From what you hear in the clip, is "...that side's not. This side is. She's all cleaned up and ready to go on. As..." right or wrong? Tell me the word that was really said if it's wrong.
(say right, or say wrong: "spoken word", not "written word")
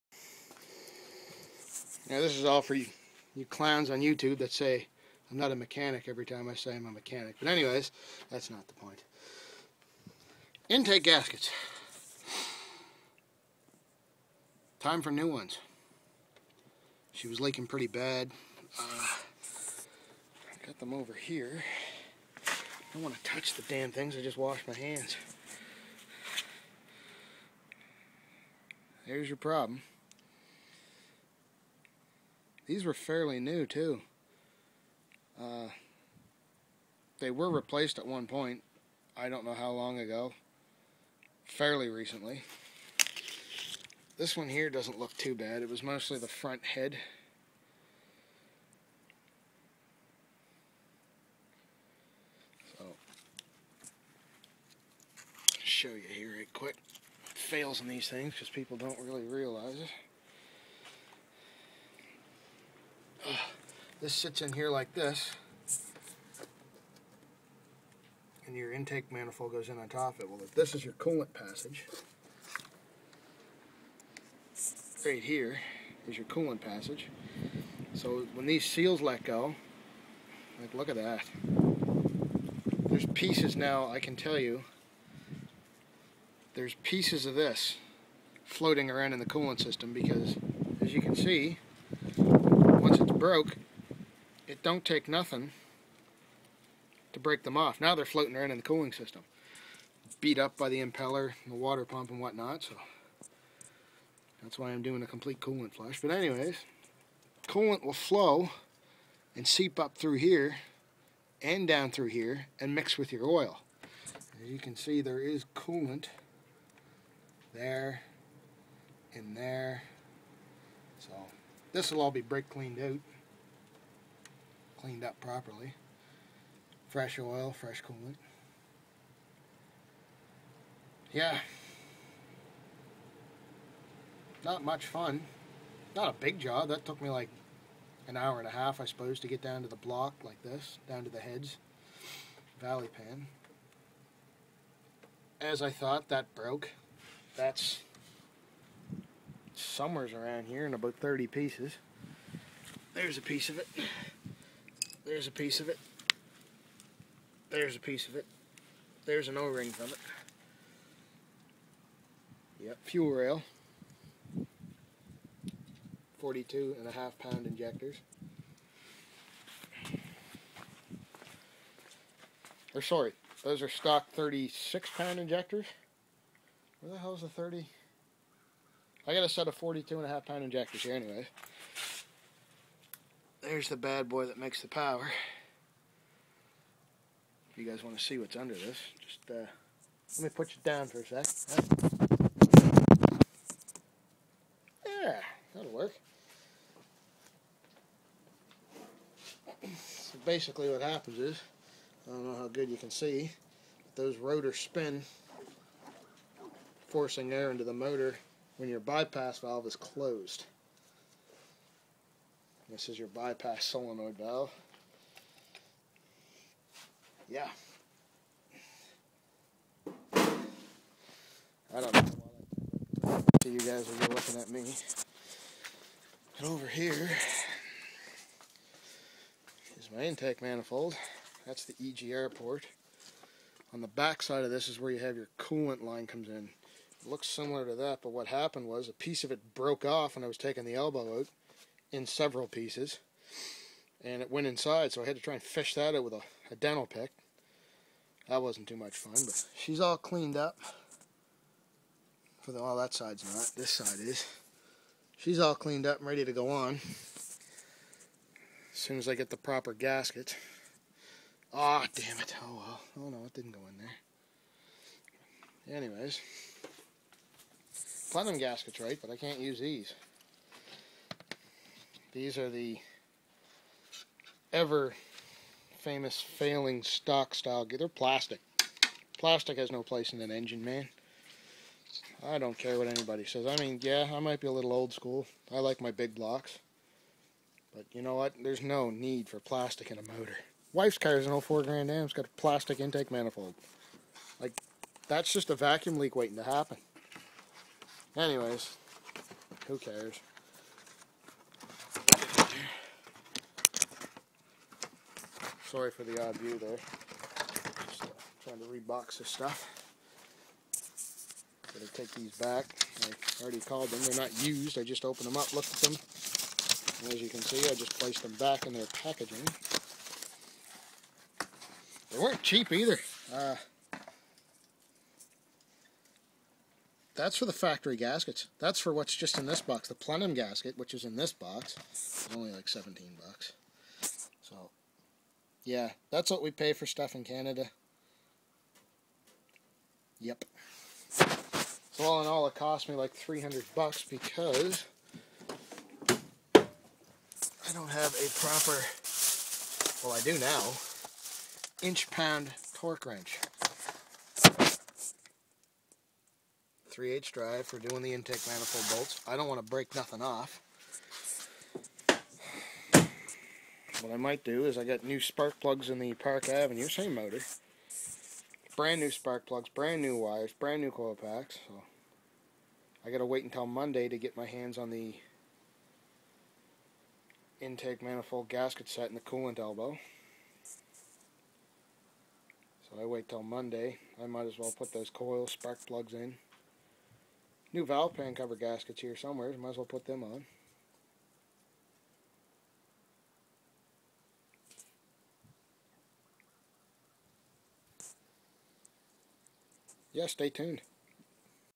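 right.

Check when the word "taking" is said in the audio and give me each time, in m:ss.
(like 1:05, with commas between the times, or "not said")
4:00.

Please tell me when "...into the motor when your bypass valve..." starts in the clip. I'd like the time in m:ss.
3:27.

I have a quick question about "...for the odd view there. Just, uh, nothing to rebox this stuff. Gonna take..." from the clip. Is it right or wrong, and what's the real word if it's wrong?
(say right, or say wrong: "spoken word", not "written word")
wrong: "trying", not "nothing".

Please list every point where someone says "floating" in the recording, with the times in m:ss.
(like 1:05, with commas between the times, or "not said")
1:28, 1:38.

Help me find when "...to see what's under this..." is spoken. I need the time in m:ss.
3:07.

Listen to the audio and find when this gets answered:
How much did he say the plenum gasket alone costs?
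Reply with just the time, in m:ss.
5:32.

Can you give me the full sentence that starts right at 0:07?
But anyways, that's not the point.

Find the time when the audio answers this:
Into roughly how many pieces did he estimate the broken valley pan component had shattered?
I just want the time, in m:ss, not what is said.
2:30.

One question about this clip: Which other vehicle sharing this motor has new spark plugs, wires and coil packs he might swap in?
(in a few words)
Park Avenue.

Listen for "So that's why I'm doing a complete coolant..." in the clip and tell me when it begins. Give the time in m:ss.
1:42.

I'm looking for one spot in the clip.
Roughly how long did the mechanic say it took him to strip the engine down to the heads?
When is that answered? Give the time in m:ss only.
2:18.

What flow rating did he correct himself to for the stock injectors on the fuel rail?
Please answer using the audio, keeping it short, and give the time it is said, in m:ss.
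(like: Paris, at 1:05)
36 pound, at 2:54.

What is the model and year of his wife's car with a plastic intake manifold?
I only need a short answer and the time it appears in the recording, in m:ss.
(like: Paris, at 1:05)
2004 Grand Am, at 4:51.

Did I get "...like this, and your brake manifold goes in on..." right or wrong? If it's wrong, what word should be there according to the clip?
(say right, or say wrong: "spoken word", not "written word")
wrong: "intake", not "brake".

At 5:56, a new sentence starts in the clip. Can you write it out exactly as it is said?
3/8 drive for doing the intake manifold bolts.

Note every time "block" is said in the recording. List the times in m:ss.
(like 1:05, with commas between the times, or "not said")
2:19, 4:46.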